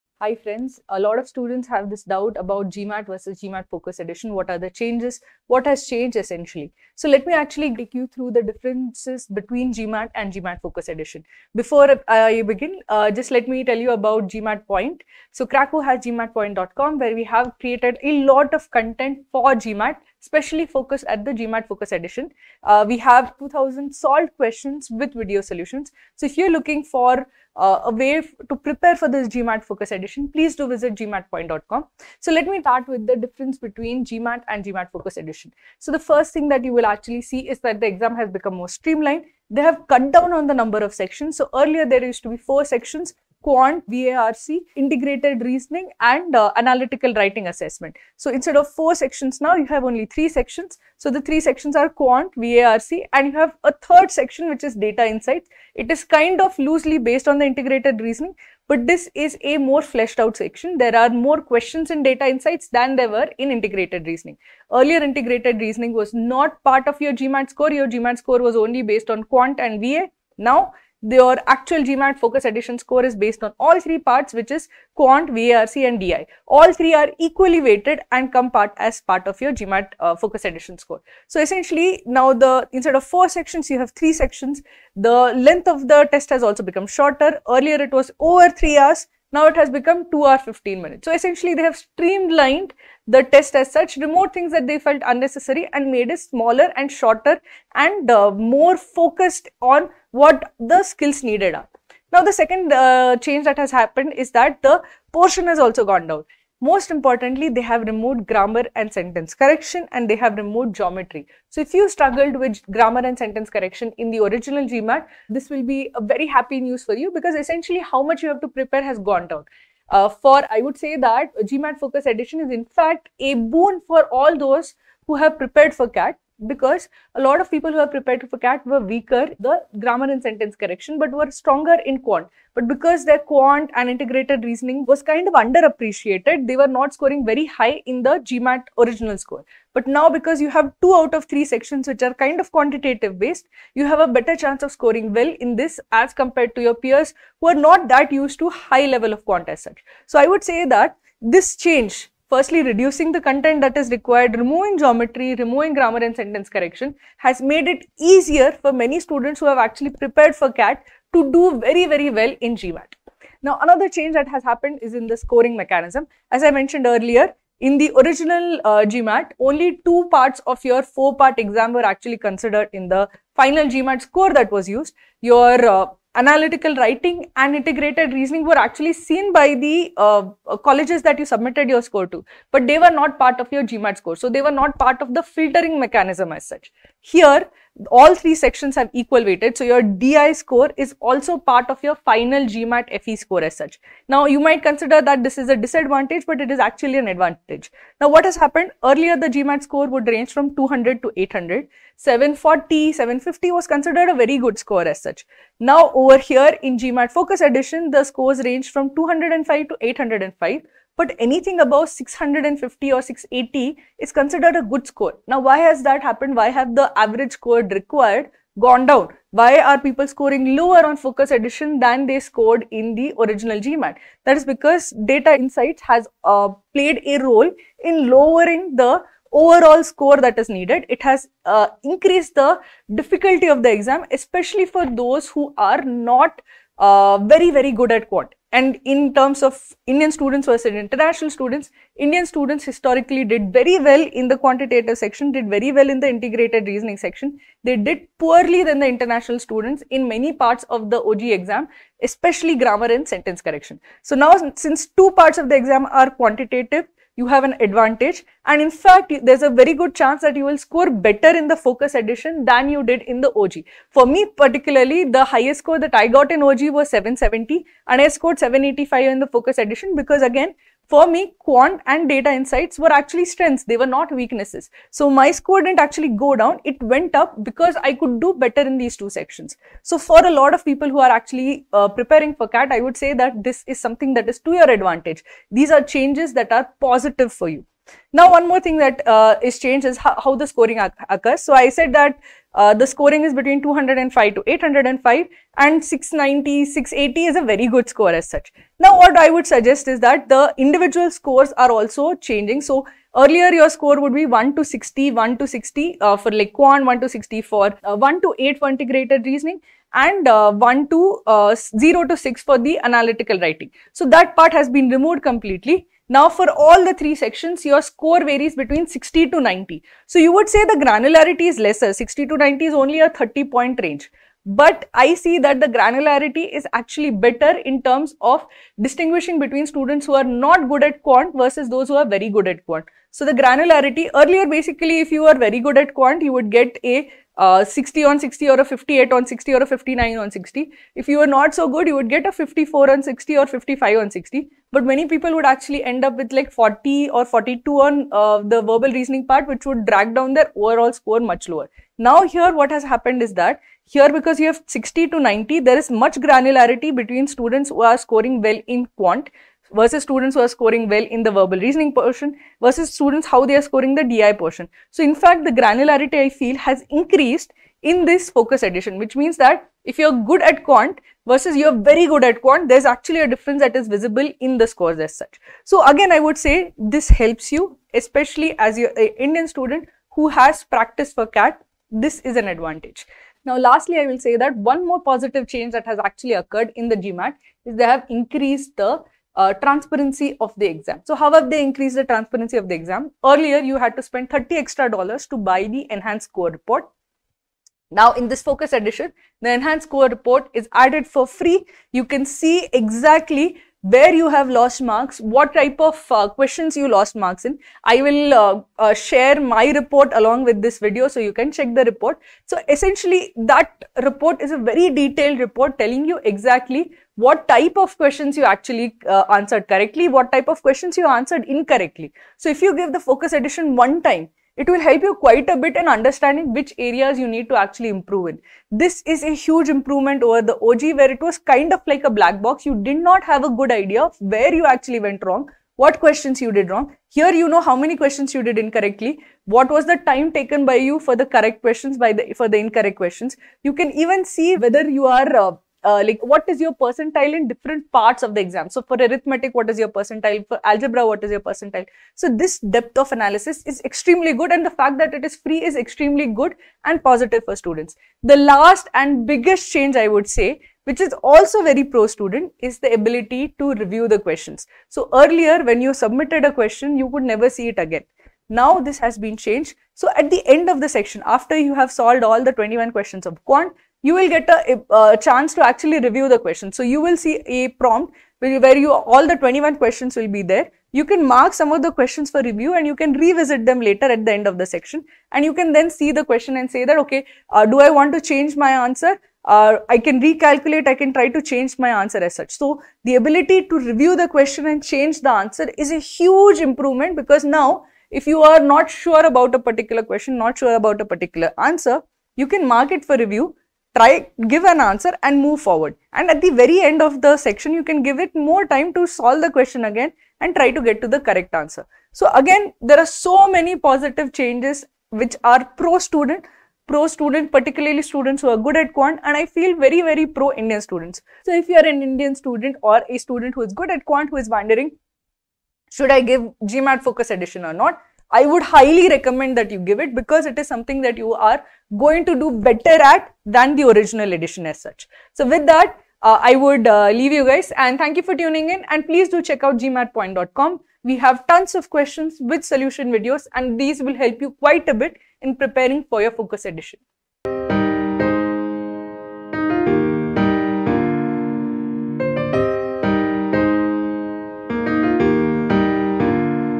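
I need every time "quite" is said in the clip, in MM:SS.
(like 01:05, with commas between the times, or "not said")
07:05, 09:04.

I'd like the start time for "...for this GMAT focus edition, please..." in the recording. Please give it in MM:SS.
00:28.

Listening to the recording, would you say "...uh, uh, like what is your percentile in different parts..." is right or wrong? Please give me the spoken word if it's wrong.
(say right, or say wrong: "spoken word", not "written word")
right.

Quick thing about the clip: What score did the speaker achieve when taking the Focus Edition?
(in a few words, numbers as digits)
785.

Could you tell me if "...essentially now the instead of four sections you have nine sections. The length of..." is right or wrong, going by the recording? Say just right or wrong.
wrong.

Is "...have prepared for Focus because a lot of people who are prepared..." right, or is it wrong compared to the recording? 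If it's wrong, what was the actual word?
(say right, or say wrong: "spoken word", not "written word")
wrong: "CAT", not "Focus".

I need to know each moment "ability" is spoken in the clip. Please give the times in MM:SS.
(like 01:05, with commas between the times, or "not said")
07:42, 08:13.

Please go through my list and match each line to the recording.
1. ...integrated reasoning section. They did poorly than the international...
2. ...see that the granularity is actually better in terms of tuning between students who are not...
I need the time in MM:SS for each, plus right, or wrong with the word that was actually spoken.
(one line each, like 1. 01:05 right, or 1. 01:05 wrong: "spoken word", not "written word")
1. 04:06 right
2. 05:25 wrong: "distinguishing", not "tuning".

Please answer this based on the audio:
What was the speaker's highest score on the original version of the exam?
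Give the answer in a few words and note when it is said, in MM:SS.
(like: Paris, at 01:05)
770, at 04:26.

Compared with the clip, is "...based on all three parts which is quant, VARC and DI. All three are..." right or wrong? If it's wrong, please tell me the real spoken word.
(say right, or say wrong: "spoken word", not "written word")
right.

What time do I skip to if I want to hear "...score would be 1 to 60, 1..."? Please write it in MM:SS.
05:03.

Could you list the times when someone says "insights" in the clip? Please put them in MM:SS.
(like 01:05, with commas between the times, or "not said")
00:55, 01:02, 03:45, 04:32.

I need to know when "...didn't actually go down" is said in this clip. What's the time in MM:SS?
04:35.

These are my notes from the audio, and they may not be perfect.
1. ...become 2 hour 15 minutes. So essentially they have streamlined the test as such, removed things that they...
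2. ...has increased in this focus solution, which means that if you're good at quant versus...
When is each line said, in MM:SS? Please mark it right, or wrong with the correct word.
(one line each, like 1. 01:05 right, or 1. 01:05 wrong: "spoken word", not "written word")
1. 01:29 right
2. 06:06 wrong: "edition", not "solution".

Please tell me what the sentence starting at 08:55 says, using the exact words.
So with that, uh, I would uh, leave you guys and thank you for tuning in and please do check out gmatpoint.com.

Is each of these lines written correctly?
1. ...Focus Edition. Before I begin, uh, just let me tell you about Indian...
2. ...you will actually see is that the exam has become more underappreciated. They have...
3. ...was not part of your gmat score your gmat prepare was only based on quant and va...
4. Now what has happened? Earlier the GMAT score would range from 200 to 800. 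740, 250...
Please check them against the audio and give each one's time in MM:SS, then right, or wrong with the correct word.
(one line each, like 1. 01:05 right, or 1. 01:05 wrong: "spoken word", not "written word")
1. 00:10 wrong: "GMAT", not "Indian"
2. 00:36 wrong: "streamlined", not "underappreciated"
3. 01:05 wrong: "score", not "prepare"
4. 03:17 wrong: "750", not "250".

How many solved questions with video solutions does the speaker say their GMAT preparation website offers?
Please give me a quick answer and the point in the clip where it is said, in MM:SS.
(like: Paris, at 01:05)
2000, at 00:23.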